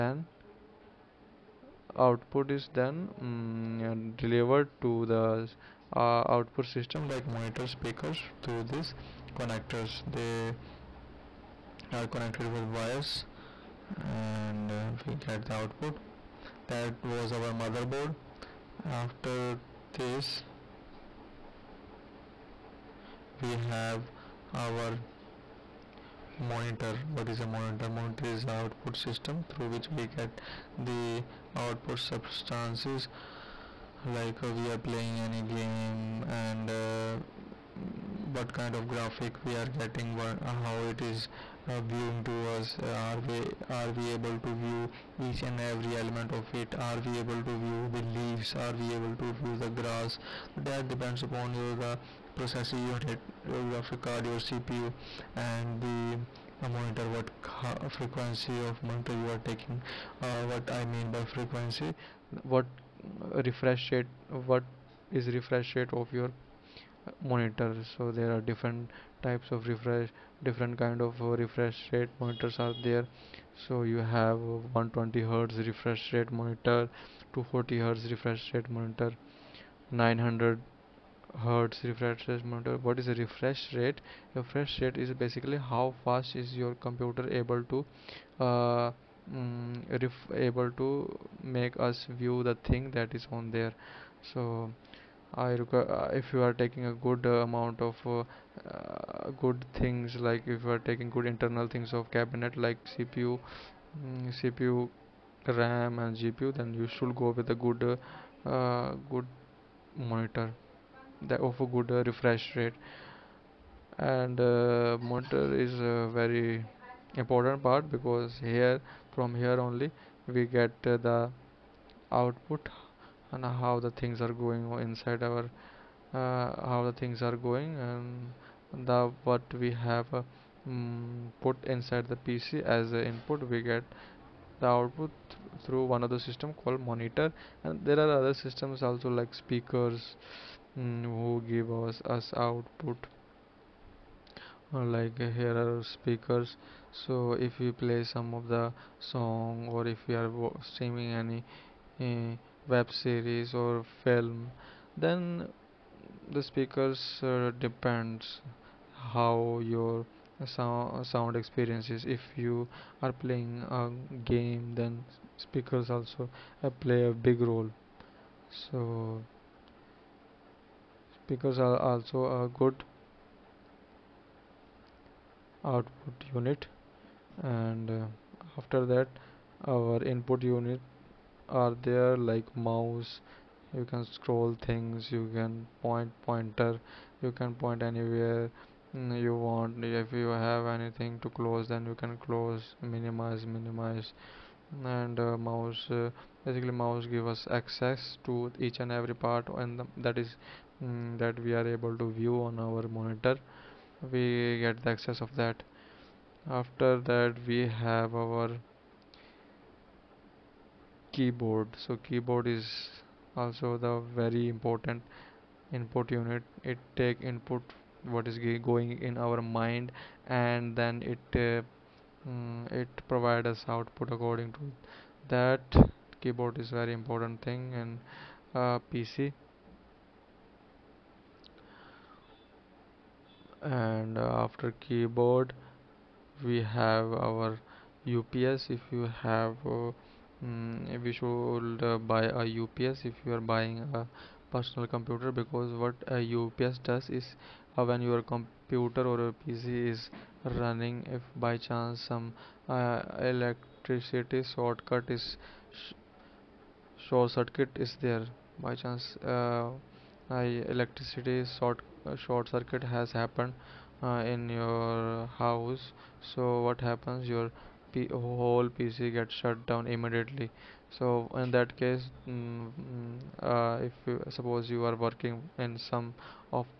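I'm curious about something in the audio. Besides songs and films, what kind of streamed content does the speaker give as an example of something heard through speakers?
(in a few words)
web series.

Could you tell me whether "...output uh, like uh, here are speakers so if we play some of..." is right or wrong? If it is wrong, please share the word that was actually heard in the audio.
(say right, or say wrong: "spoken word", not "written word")
right.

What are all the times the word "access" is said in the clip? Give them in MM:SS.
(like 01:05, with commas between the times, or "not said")
03:17, 03:24.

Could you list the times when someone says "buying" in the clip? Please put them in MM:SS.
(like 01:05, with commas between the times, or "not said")
04:03.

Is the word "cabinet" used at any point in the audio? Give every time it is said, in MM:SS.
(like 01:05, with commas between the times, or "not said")
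01:42.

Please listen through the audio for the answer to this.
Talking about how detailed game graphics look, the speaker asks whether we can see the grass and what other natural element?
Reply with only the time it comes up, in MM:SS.
00:48.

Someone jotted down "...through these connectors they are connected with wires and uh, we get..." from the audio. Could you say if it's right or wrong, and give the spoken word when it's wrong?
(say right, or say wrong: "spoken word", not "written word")
right.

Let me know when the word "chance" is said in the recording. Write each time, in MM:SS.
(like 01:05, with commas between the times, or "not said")
04:11, 04:18.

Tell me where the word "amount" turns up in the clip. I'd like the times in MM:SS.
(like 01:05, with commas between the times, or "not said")
01:37.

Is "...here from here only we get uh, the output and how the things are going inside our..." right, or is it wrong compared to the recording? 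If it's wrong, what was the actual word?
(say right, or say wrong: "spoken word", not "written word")
right.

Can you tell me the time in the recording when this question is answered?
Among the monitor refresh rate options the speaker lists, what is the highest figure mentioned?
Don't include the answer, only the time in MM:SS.
01:19.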